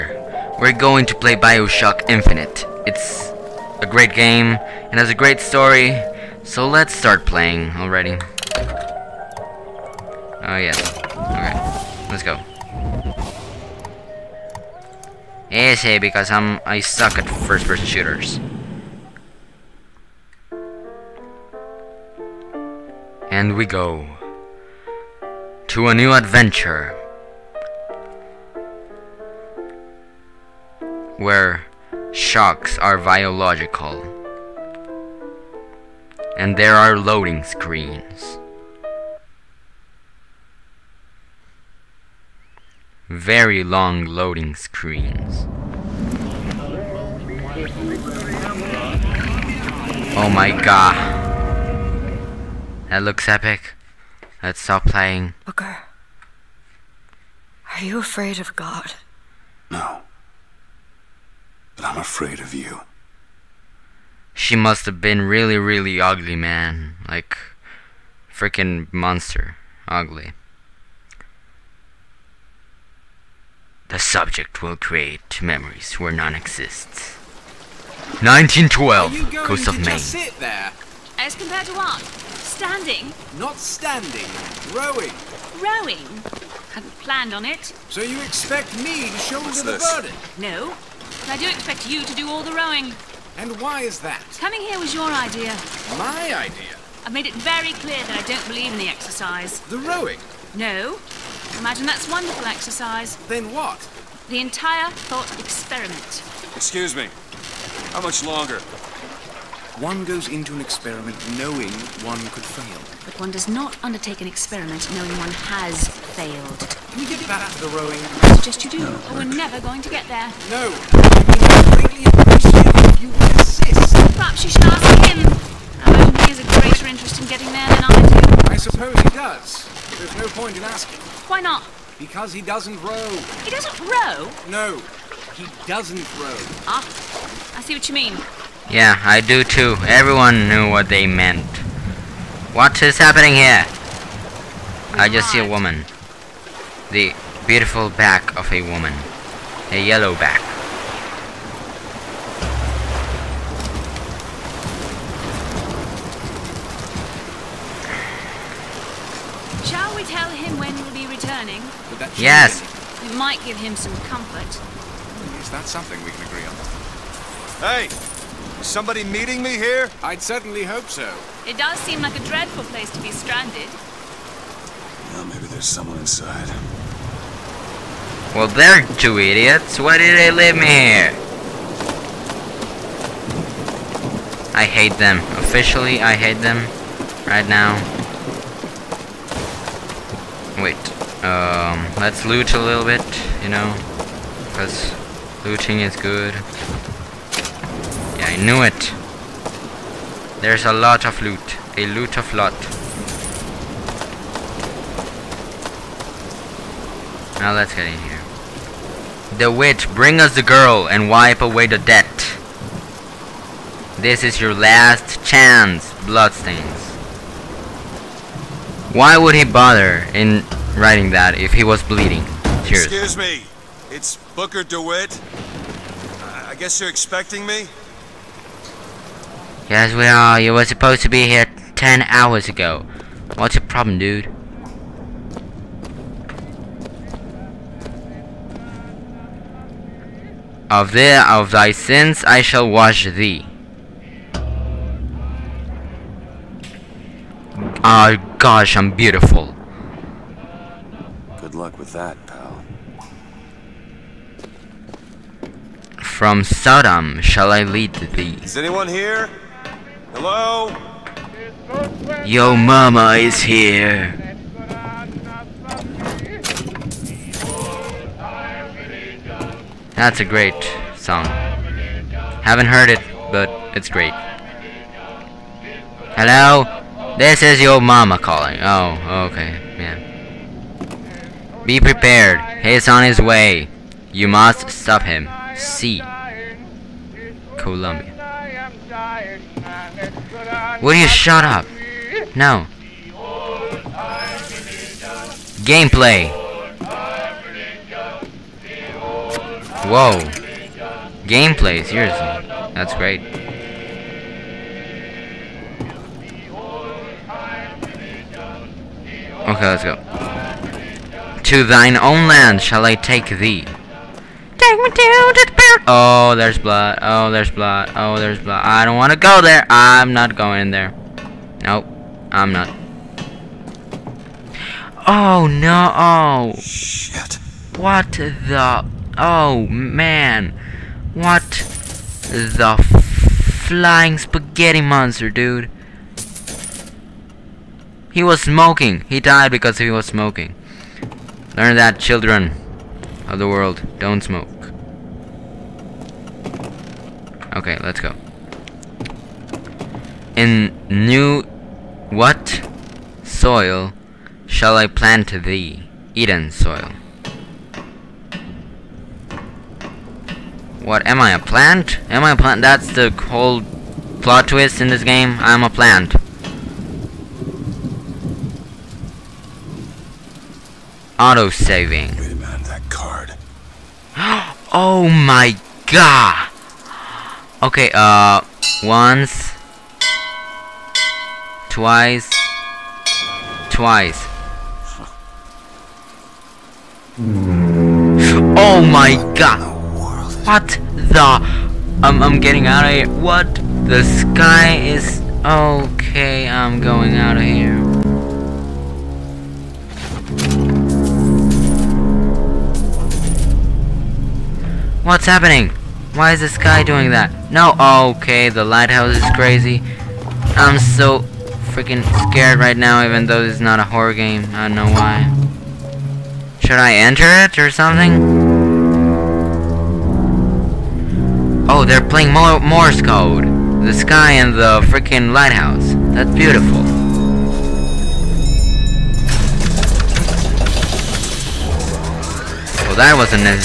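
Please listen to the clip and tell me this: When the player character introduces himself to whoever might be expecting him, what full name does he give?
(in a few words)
Booker DeWitt.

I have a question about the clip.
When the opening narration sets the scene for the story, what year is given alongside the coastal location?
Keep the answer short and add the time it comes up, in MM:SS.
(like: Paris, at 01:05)
1912, at 01:18.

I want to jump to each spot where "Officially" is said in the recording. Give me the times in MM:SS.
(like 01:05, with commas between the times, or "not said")
03:05.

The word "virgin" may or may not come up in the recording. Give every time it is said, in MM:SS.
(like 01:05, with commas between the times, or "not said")
not said.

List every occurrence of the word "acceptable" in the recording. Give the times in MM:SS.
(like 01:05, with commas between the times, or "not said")
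not said.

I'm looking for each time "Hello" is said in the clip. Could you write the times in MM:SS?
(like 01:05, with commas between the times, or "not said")
04:20, 04:36.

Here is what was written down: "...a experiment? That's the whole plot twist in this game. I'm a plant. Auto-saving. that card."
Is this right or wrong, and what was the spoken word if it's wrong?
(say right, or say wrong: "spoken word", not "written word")
wrong: "plant", not "experiment".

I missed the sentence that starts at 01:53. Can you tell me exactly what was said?
But one does not undertake an experiment knowing one has failed.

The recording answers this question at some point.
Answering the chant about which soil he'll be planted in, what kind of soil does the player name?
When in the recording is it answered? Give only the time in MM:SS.
05:56.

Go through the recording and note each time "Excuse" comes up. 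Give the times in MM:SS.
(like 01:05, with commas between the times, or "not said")
01:46, 03:42.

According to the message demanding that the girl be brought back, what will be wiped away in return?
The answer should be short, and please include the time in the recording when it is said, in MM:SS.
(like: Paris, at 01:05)
The debt, at 03:31.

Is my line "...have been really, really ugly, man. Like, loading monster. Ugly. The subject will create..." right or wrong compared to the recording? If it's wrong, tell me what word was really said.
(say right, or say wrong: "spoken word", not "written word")
wrong: "freaking", not "loading".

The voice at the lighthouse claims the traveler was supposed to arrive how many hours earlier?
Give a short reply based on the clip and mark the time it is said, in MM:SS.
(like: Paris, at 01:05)
10 hours, at 03:51.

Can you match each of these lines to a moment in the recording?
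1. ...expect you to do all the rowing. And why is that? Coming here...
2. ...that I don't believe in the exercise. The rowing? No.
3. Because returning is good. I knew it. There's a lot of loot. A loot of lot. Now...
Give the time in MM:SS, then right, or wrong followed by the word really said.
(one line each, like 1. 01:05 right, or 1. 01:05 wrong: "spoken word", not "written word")
1. 01:31 right
2. 01:38 right
3. 03:14 wrong: "looting", not "returning".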